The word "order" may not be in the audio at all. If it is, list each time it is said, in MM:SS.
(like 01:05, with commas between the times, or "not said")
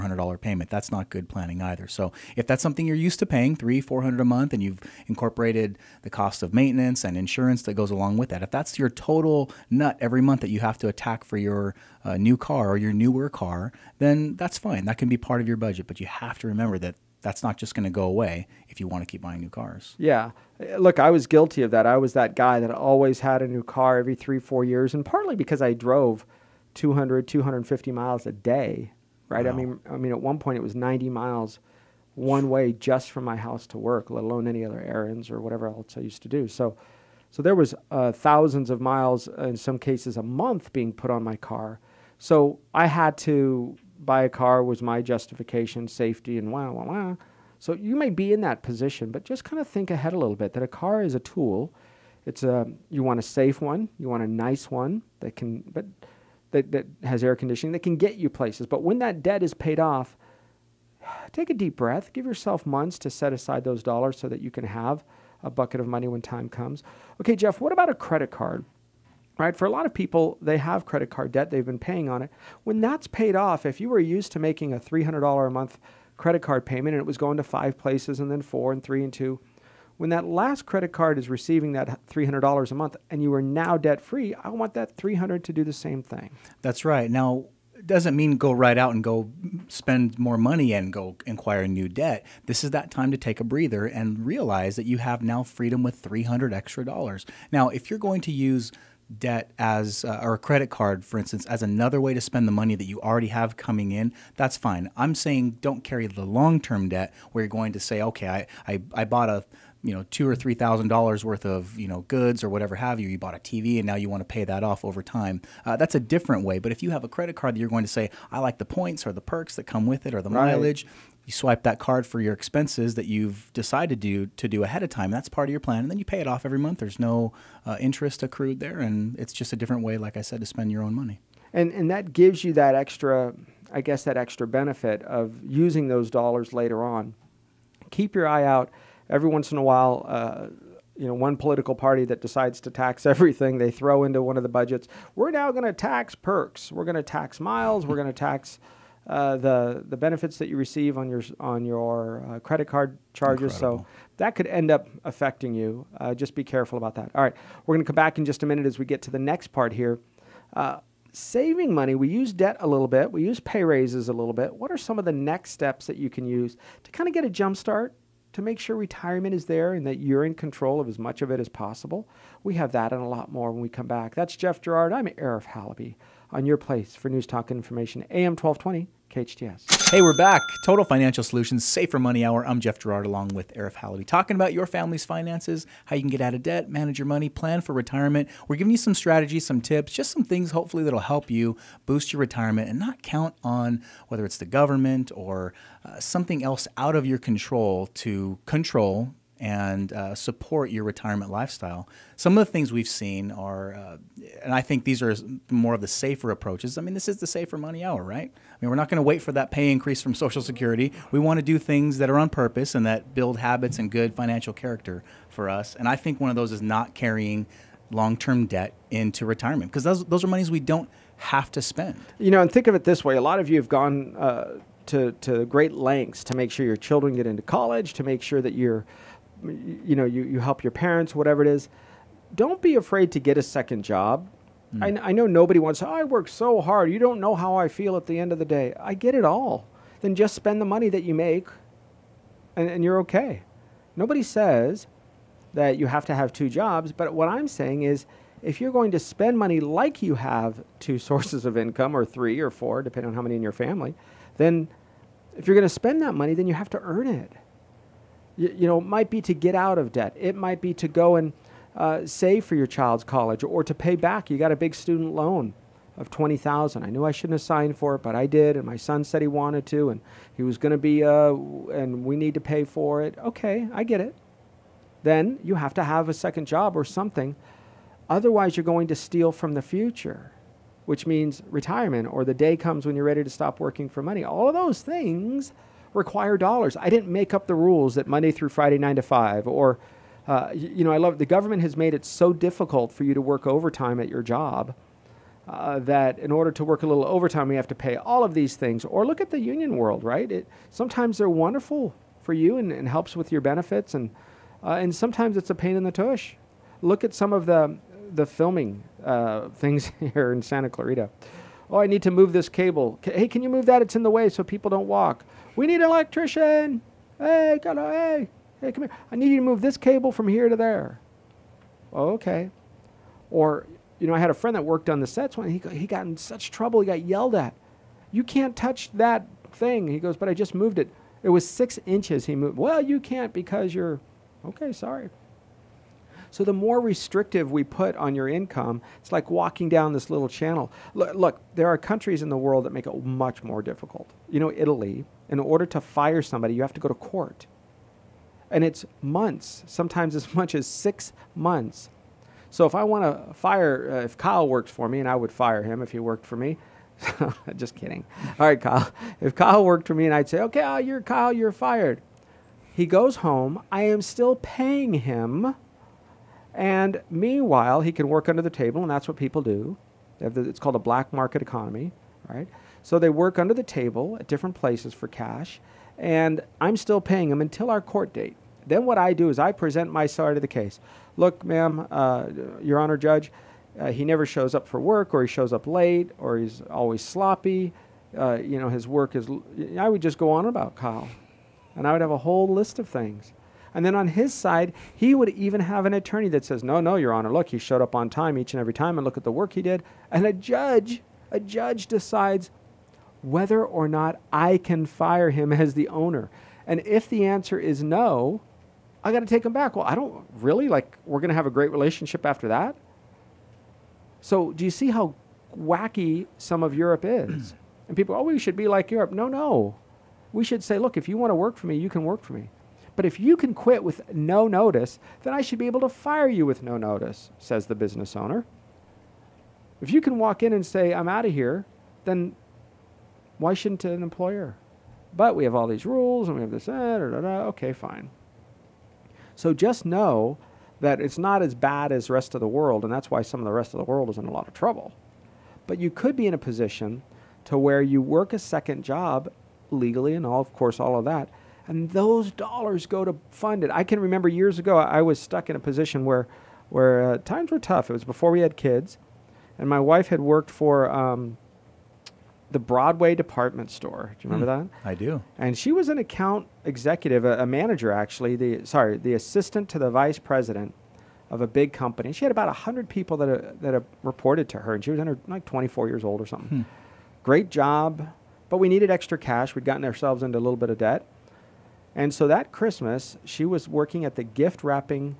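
04:56, 05:45.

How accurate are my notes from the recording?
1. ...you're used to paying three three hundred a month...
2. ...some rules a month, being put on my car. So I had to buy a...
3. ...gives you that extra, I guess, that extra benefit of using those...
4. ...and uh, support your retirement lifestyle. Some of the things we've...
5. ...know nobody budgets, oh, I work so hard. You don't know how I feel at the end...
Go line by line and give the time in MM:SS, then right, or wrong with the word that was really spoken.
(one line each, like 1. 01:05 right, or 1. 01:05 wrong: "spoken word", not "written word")
1. 00:02 wrong: "four", not "three"
2. 00:39 wrong: "cases", not "rules"
3. 02:12 right
4. 03:19 right
5. 03:55 wrong: "wants", not "budgets".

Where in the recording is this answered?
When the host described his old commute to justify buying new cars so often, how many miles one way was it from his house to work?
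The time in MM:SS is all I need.
00:30.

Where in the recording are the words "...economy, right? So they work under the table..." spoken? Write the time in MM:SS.
06:11.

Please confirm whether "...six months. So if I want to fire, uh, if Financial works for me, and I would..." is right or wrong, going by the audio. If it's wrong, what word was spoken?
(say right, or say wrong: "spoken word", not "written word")
wrong: "Kyle", not "Financial".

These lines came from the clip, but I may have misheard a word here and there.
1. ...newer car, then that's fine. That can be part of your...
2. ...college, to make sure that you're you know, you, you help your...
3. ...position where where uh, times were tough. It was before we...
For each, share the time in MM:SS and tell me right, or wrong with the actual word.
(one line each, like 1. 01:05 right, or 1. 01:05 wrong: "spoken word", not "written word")
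1. 00:12 right
2. 03:47 right
3. 07:35 right.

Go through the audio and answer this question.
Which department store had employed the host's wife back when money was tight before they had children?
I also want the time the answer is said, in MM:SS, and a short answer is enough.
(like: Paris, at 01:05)
Broadway, at 07:42.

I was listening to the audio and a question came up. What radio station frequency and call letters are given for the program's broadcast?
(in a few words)
AM 1220, KHTS.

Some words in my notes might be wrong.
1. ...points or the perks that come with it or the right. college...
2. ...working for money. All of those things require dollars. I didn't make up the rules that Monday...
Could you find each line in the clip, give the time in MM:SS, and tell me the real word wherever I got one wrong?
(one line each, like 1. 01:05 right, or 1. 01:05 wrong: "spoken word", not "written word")
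1. 01:58 wrong: "mileage", not "college"
2. 04:43 right.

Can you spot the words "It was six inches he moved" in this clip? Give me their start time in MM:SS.
05:31.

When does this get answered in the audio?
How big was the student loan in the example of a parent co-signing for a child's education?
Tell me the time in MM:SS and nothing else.
04:26.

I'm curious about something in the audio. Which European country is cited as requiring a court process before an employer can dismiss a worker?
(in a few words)
Italy.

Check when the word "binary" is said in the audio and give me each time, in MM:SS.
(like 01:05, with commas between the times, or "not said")
not said.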